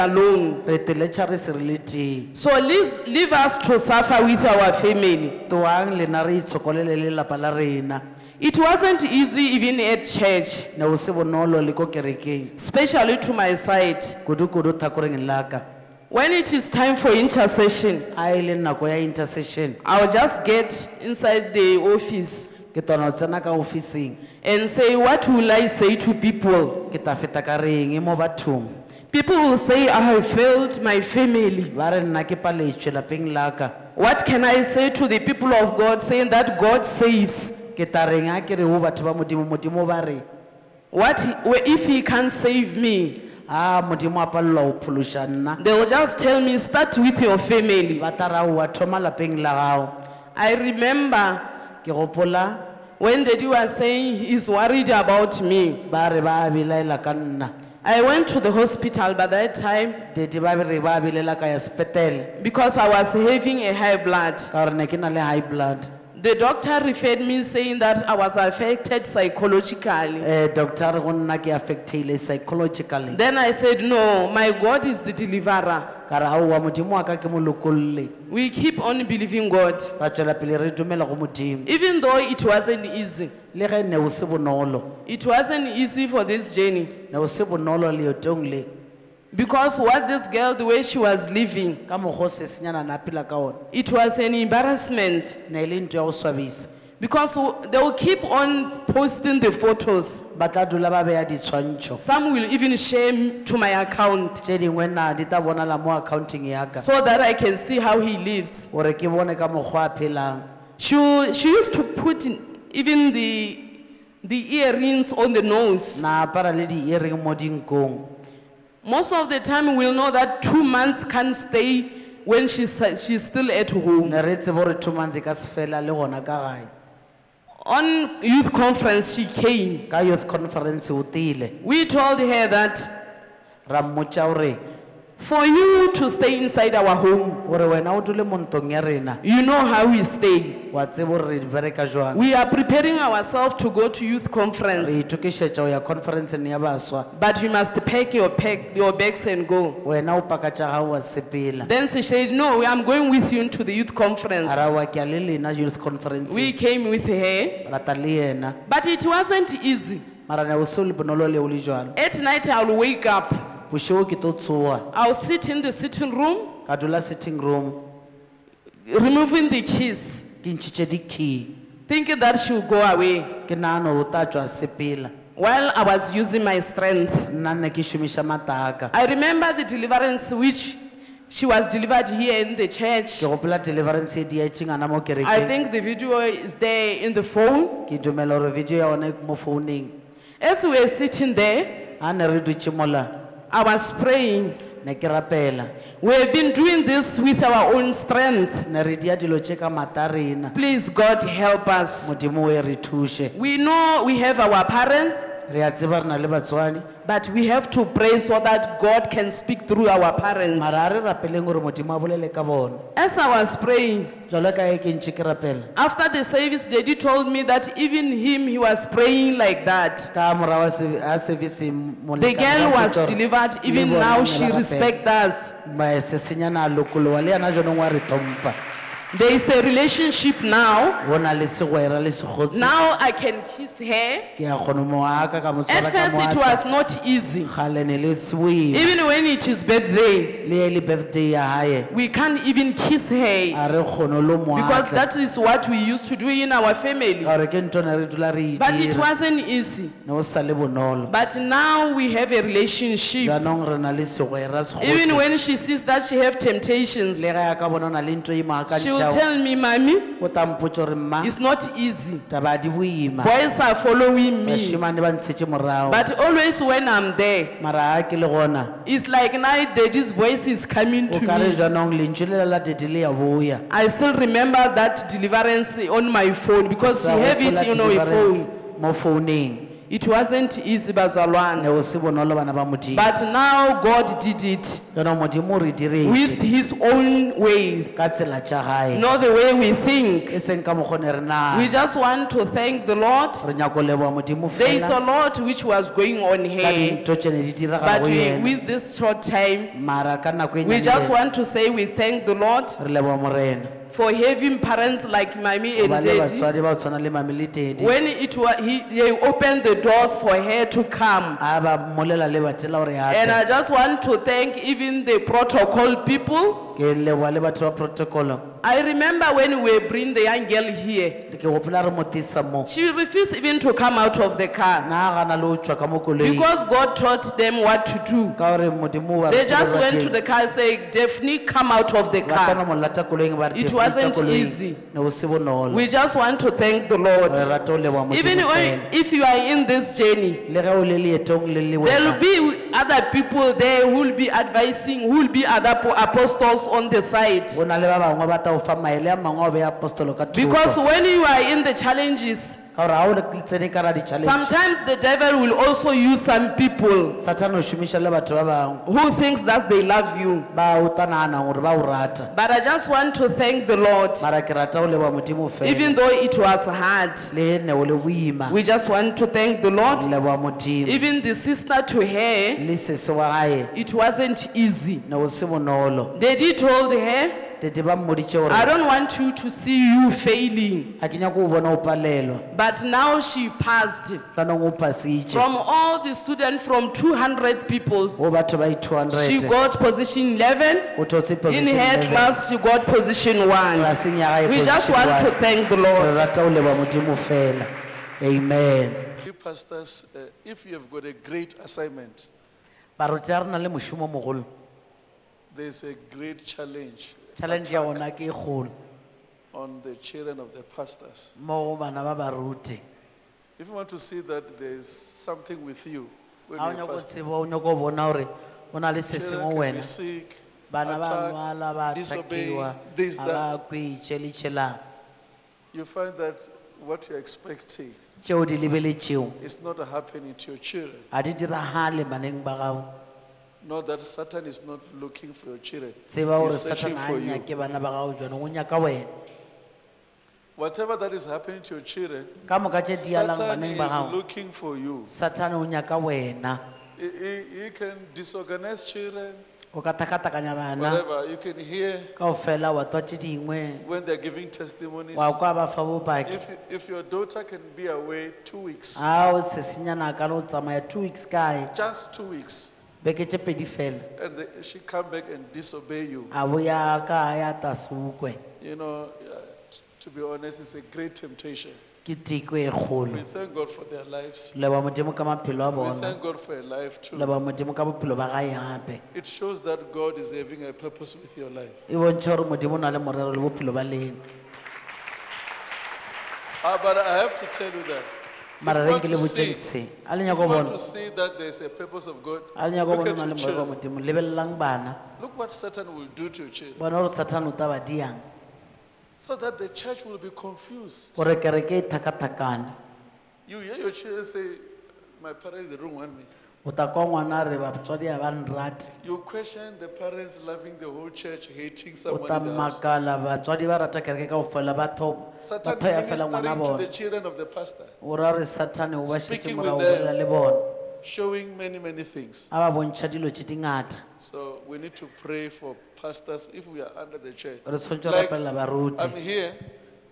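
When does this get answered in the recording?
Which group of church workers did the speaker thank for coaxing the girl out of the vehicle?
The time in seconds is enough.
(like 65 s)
315 s.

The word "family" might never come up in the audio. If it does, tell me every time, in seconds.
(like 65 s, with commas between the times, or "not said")
4 s, 31 s, 47 s, 246 s.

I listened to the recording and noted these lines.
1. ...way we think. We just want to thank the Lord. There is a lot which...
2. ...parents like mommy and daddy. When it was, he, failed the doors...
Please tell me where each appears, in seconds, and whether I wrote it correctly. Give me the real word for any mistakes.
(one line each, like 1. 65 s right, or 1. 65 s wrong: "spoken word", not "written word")
1. 289 s right
2. 304 s wrong: "opened", not "failed".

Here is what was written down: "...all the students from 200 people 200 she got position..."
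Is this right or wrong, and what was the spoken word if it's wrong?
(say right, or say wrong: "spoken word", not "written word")
right.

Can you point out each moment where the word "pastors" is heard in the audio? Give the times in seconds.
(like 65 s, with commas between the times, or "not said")
399 s, 410 s, 416 s, 517 s, 526 s.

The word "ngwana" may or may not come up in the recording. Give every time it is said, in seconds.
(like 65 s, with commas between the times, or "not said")
507 s, 516 s.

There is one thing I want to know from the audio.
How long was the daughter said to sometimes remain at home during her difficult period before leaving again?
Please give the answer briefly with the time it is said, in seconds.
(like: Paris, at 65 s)
2 months, at 120 s.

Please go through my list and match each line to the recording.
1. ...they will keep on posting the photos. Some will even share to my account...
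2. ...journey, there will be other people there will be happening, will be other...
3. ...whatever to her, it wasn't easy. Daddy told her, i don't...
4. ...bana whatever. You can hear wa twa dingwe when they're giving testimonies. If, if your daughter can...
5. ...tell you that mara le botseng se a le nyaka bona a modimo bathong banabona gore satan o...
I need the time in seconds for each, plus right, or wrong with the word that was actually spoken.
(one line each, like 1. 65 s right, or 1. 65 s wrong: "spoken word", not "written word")
1. 97 s right
2. 339 s wrong: "advising", not "happening"
3. 371 s wrong: "sister", not "whatever"
4. 450 s right
5. 487 s wrong: "lebelelang", not "bathong".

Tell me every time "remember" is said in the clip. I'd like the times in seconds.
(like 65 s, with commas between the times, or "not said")
50 s, 179 s, 274 s, 318 s.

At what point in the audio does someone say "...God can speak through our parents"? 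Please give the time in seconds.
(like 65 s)
208 s.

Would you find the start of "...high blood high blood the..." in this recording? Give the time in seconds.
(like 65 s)
63 s.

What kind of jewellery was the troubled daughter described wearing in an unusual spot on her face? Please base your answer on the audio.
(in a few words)
Earrings.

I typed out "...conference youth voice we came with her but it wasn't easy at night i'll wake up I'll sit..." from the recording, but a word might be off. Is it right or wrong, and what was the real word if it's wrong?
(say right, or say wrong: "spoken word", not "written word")
wrong: "conference", not "voice".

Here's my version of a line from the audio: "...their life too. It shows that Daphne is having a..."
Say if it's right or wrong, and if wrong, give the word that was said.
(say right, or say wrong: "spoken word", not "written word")
wrong: "God", not "Daphne".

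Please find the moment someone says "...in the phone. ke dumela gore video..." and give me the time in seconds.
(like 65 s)
186 s.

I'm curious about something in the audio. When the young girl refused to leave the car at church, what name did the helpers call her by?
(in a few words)
Daphne.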